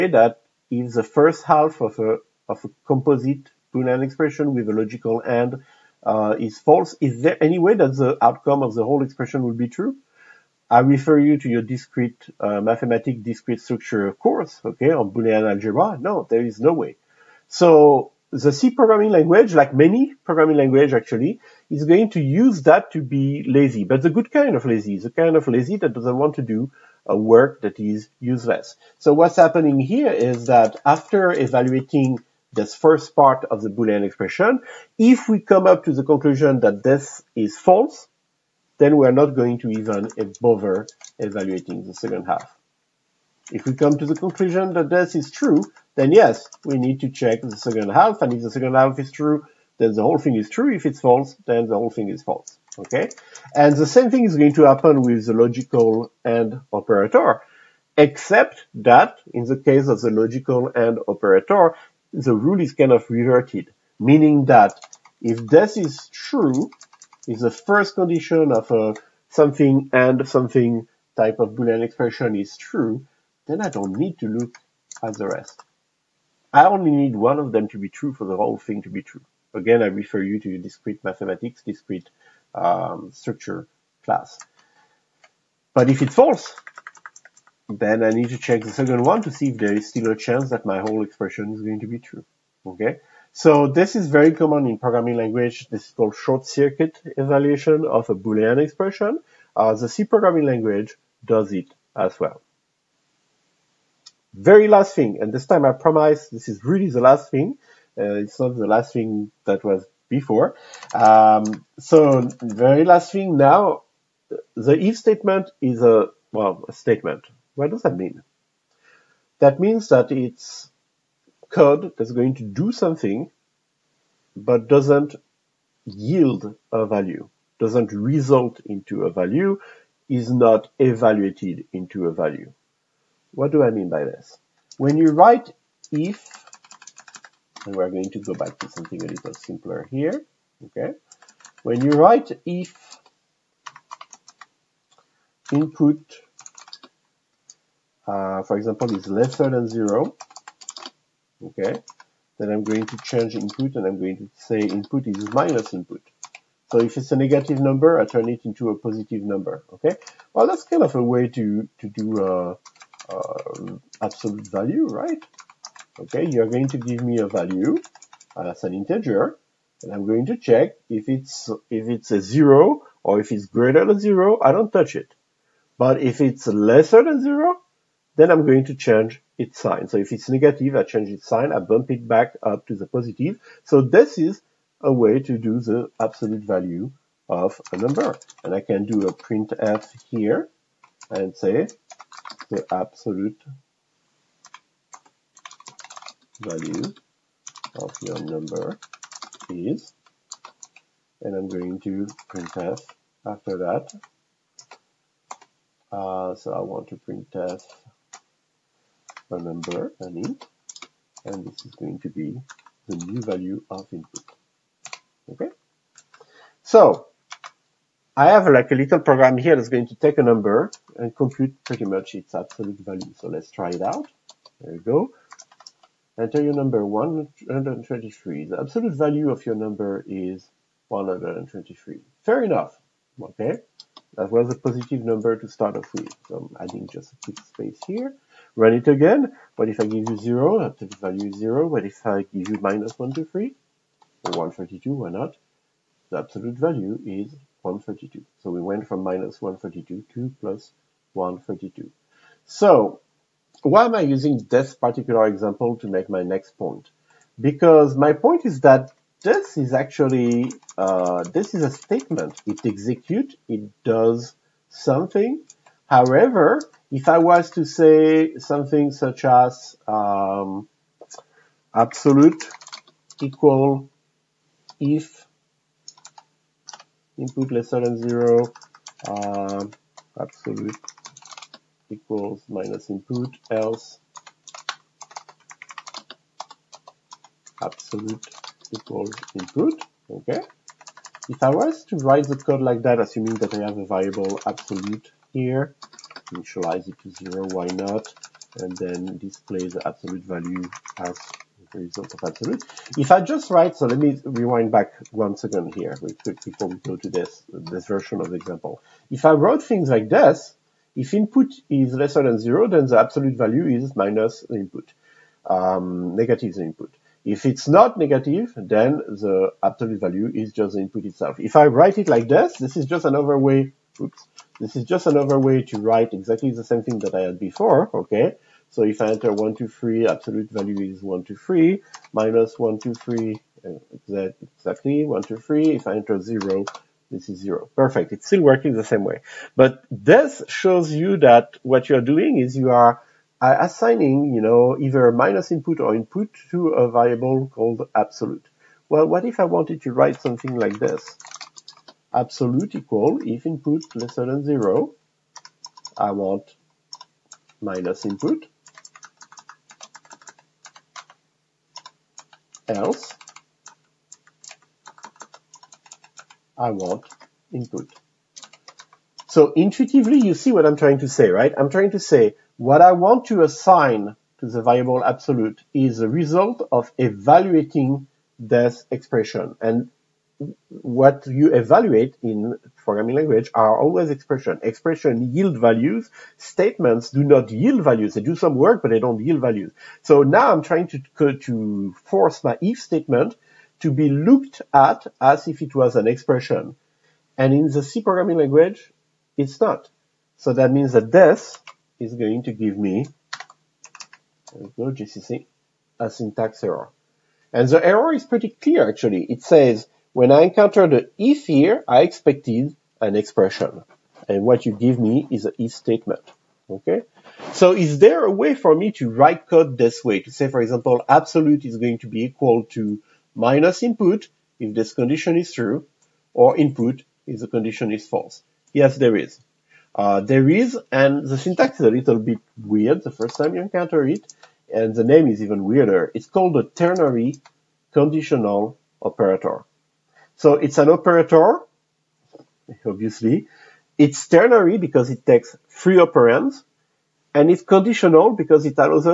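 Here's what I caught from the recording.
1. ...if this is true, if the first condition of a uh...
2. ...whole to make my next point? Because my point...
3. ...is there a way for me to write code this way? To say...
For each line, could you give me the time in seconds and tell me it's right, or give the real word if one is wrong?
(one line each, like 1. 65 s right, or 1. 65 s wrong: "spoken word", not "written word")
1. 65 s right
2. 255 s wrong: "example", not "whole"
3. 417 s right.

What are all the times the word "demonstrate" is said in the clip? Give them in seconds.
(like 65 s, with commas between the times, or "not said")
not said.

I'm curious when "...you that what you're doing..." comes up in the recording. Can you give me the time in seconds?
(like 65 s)
340 s.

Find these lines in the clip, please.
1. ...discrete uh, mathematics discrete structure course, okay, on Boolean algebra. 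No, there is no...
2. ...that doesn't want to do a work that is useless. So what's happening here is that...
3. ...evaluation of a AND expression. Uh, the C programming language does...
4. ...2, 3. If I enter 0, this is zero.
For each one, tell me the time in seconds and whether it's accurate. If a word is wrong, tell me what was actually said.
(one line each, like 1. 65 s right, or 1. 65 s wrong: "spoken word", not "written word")
1. 11 s right
2. 25 s right
3. 97 s wrong: "Boolean", not "AND"
4. 335 s right.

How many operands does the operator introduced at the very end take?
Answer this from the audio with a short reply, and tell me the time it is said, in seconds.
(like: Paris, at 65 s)
3, at 445 s.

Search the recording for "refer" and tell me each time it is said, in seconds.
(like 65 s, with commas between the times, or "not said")
10 s, 79 s.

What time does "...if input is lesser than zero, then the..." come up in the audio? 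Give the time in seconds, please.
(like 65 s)
310 s.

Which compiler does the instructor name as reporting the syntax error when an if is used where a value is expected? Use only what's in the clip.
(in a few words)
GCC.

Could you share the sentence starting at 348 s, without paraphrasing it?
Well, what if I wanted to write something like this?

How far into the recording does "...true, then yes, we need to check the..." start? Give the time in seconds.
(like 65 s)
45 s.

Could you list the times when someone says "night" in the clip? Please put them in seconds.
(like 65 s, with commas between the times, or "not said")
not said.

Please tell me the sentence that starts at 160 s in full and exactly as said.
Well, that's kind of a way to, to do uh, uh, absolute value, right?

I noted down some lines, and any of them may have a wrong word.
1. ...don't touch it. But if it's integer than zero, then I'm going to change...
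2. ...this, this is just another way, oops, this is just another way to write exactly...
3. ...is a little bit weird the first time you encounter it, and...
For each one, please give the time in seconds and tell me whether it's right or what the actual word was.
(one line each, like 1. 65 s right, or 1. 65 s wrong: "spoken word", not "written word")
1. 174 s wrong: "lesser", not "integer"
2. 322 s right
3. 431 s right.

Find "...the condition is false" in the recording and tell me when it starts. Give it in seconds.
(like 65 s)
427 s.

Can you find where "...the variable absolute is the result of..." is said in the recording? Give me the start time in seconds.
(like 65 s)
374 s.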